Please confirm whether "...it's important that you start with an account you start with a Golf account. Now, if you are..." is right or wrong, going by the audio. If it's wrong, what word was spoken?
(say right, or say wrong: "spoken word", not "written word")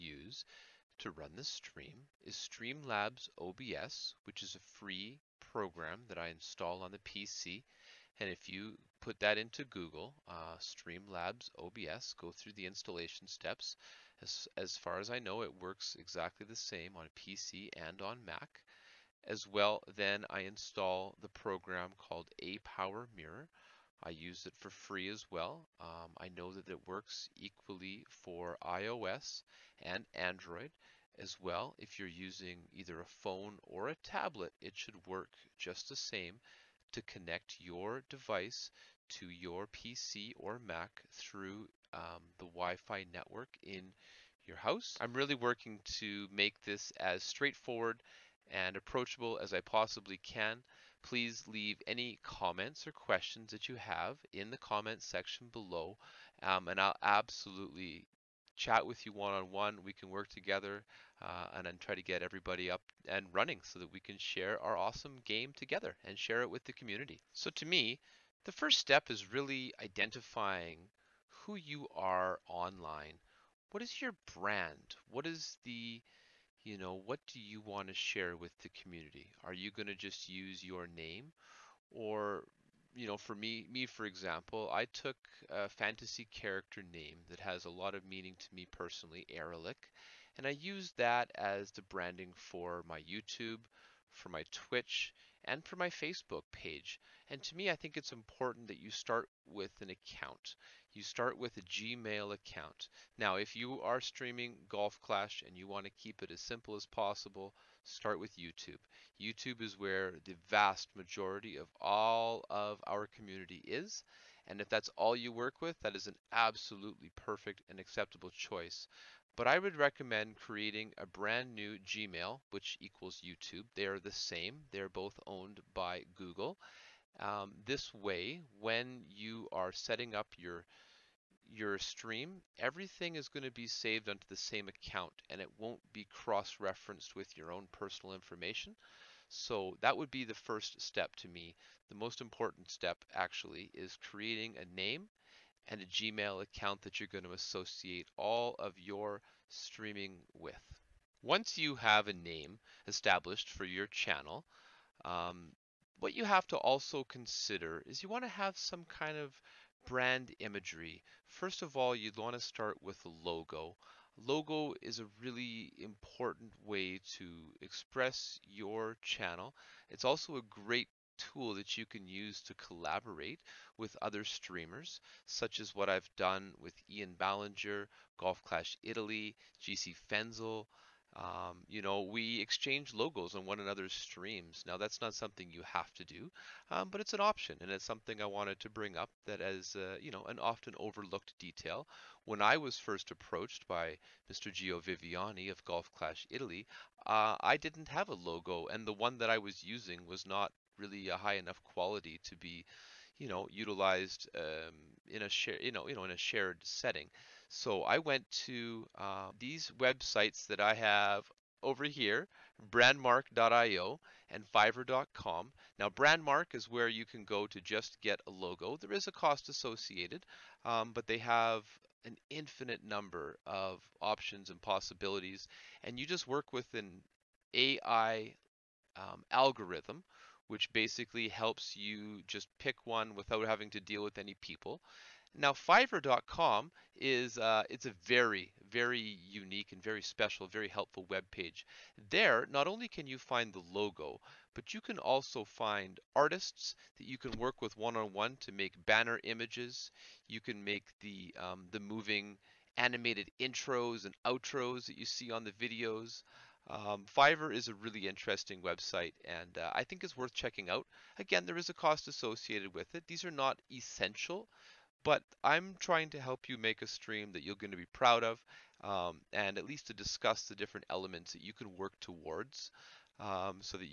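wrong: "Gmail", not "Golf".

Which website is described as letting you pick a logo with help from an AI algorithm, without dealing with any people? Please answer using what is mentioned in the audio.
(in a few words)
brandmark.io.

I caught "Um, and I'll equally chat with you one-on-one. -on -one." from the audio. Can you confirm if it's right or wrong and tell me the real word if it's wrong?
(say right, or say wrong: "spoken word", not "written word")
wrong: "absolutely", not "equally".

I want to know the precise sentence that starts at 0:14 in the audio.
As, as far as I know, it works exactly the same on PC and on Mac.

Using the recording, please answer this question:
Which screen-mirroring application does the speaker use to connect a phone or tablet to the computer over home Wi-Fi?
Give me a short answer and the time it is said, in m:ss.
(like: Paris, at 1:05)
ApowerMirror, at 0:22.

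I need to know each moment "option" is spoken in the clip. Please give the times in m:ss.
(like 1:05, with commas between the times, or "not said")
3:07, 3:44.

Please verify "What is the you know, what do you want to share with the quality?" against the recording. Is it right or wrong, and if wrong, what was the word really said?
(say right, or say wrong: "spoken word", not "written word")
wrong: "community", not "quality".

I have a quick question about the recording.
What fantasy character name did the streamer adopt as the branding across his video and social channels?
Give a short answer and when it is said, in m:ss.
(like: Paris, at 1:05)
Erelic, at 1:29.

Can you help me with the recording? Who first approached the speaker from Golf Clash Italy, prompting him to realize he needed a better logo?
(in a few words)
Gio Viviani.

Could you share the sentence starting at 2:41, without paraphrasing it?
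First of all, you'd want to start with a logo.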